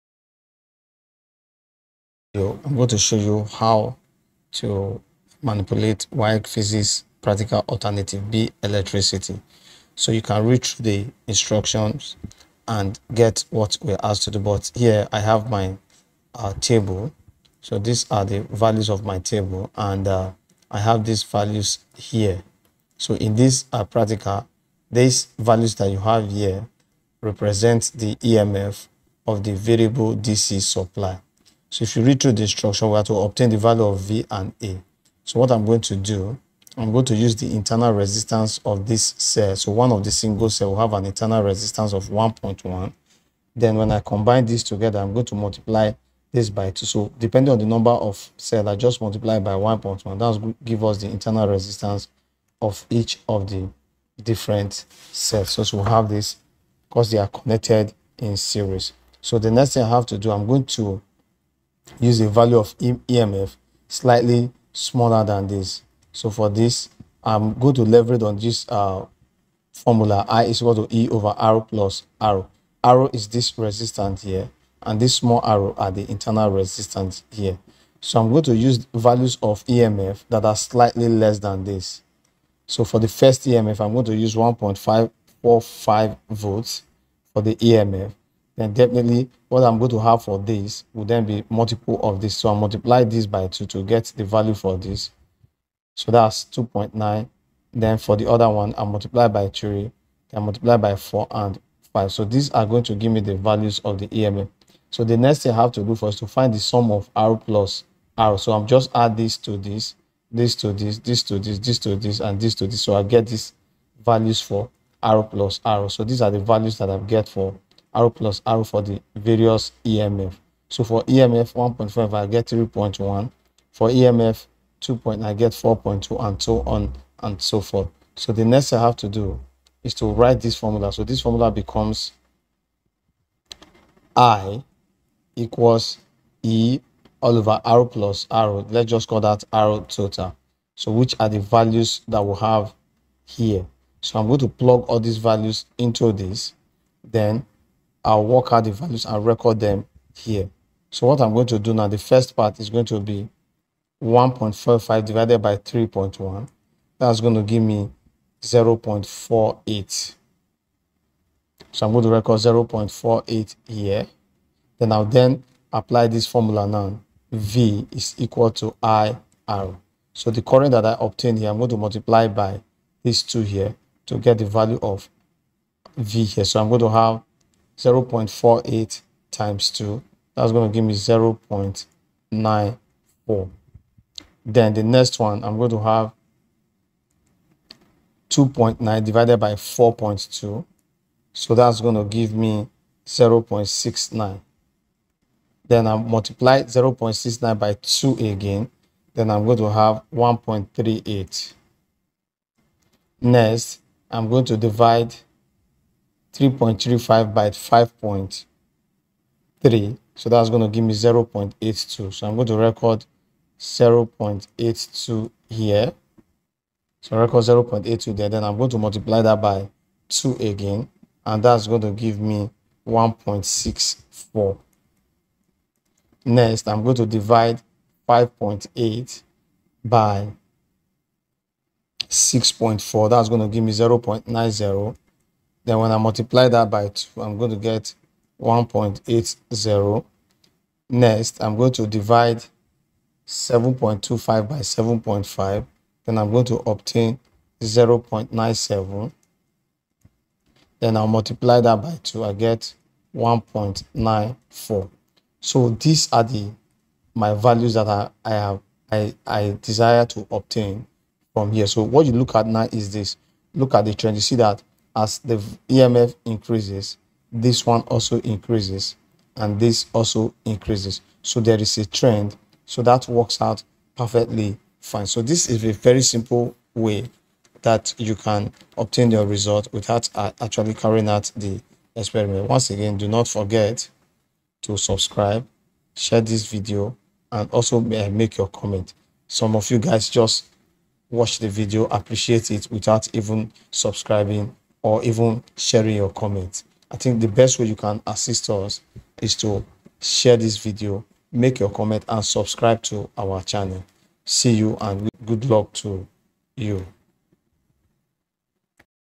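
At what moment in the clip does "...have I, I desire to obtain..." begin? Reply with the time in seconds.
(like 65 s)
258 s.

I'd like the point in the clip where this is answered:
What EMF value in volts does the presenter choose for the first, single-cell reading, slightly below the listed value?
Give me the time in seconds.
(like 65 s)
84 s.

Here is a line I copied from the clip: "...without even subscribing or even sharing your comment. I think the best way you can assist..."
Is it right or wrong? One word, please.
right.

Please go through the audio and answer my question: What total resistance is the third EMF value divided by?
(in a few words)
5.3.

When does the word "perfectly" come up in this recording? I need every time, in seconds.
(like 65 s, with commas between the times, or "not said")
273 s.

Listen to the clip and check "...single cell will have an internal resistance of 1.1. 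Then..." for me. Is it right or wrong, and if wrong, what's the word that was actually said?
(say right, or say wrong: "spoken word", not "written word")
right.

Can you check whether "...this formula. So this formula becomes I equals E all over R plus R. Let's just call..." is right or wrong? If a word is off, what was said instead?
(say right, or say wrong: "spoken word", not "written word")
right.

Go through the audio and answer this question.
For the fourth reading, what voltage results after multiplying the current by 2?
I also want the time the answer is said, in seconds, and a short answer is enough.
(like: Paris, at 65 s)
1.80, at 238 s.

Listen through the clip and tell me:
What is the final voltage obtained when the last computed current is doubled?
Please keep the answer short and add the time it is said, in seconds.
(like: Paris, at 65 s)
1.94, at 253 s.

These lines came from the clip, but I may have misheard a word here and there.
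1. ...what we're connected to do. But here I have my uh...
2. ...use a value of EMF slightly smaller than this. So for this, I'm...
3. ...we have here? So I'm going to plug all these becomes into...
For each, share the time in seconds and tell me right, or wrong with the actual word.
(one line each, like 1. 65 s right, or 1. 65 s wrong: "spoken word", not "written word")
1. 13 s wrong: "asked", not "connected"
2. 61 s right
3. 142 s wrong: "values", not "becomes".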